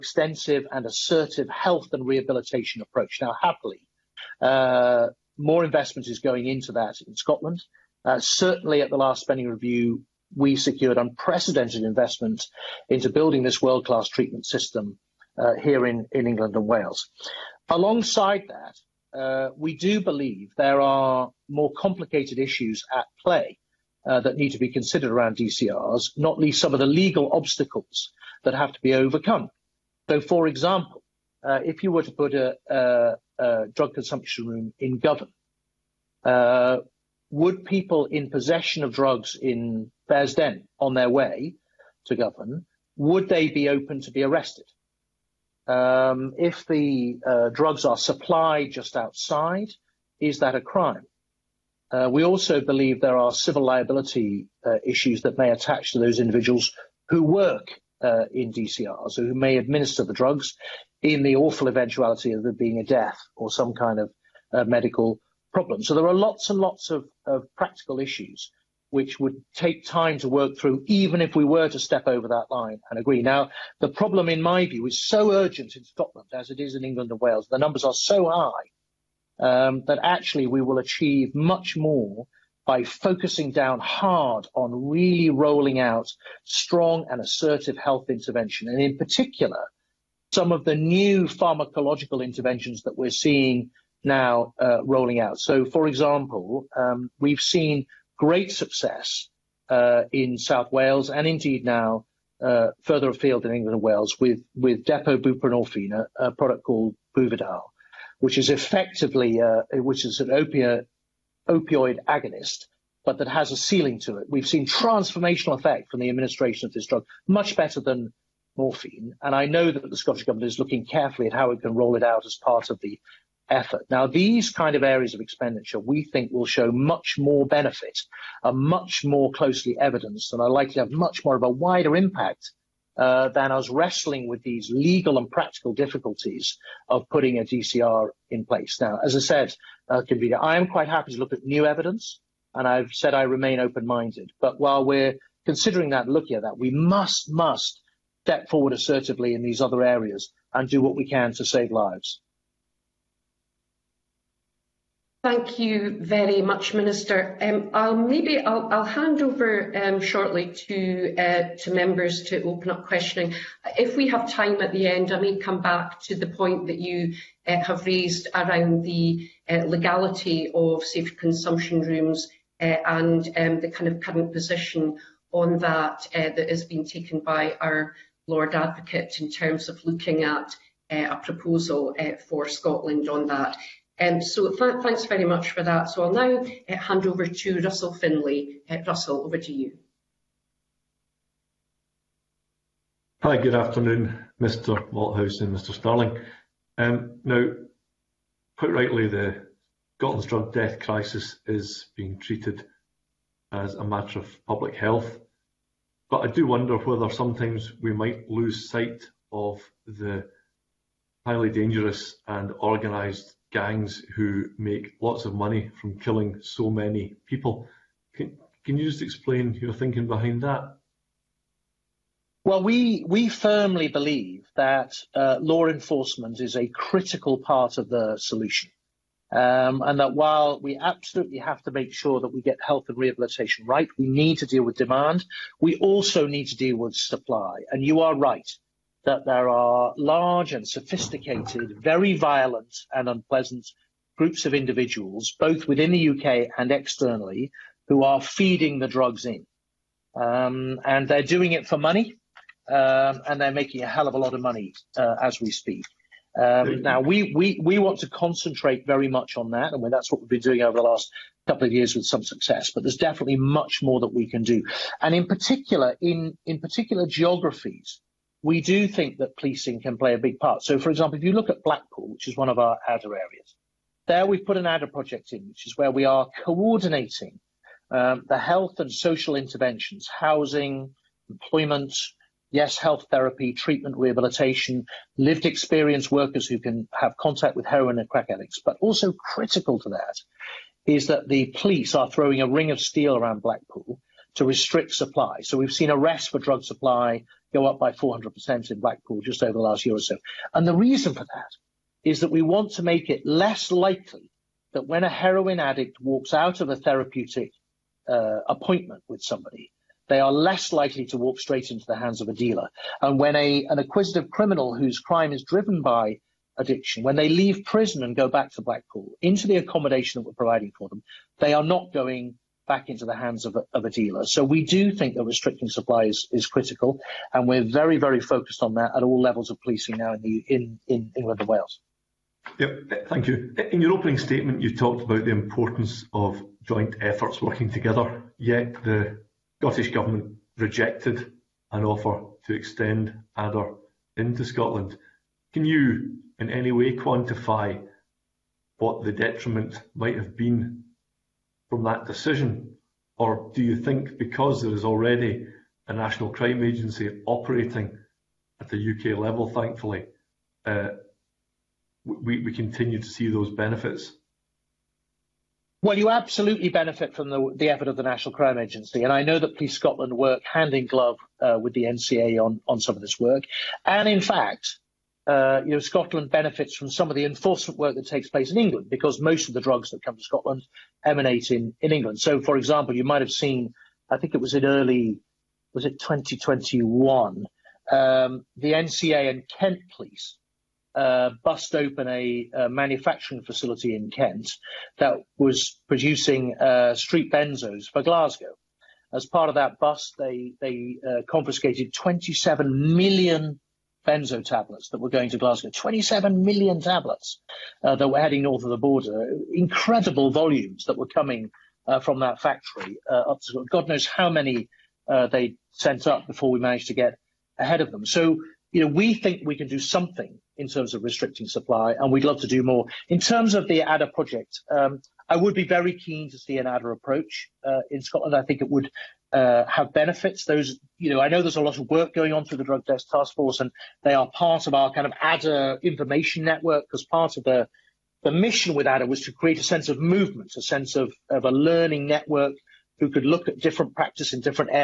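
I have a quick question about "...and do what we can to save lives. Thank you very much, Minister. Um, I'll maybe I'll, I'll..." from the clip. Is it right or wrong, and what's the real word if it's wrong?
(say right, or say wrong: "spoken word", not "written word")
right.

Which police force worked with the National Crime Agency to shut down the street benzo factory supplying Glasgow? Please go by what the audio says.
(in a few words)
Kent police.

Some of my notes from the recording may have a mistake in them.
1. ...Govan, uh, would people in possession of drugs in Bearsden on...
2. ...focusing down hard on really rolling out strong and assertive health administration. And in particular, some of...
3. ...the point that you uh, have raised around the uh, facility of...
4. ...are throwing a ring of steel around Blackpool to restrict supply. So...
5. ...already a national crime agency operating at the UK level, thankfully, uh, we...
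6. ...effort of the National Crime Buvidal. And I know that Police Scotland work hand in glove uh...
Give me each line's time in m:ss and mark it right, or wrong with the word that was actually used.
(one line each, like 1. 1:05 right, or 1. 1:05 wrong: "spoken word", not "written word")
1. 0:34 right
2. 1:22 wrong: "intervention", not "administration"
3. 2:46 wrong: "legality", not "facility"
4. 4:51 right
5. 5:54 right
6. 6:07 wrong: "Agency", not "Buvidal".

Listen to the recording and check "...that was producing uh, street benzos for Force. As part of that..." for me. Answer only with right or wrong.
wrong.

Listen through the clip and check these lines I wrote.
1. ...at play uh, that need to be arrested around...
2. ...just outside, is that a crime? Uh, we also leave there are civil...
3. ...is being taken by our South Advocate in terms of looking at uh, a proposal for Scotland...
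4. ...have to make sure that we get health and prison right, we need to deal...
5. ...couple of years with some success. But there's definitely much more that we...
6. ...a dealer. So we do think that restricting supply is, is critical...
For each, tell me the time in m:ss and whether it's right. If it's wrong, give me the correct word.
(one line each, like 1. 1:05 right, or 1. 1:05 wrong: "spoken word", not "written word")
1. 0:22 wrong: "considered", not "arrested"
2. 0:48 wrong: "believe", not "leave"
3. 2:56 wrong: "Lord", not "South"
4. 3:51 wrong: "rehabilitation", not "prison"
5. 4:21 right
6. 5:23 right.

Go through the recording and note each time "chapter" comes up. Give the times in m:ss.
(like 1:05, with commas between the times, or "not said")
not said.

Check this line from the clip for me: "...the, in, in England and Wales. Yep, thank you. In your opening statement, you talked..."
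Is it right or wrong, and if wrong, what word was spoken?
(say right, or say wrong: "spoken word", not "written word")
right.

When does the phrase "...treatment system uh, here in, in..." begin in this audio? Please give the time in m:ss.
0:14.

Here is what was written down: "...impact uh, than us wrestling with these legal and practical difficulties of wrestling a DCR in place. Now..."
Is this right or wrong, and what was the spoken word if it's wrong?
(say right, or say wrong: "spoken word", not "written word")
wrong: "putting", not "wrestling".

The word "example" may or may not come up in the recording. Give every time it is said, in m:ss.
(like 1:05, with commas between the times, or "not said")
0:30, 1:35, 4:30, 6:22.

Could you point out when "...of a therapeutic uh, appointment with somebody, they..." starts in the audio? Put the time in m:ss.
5:06.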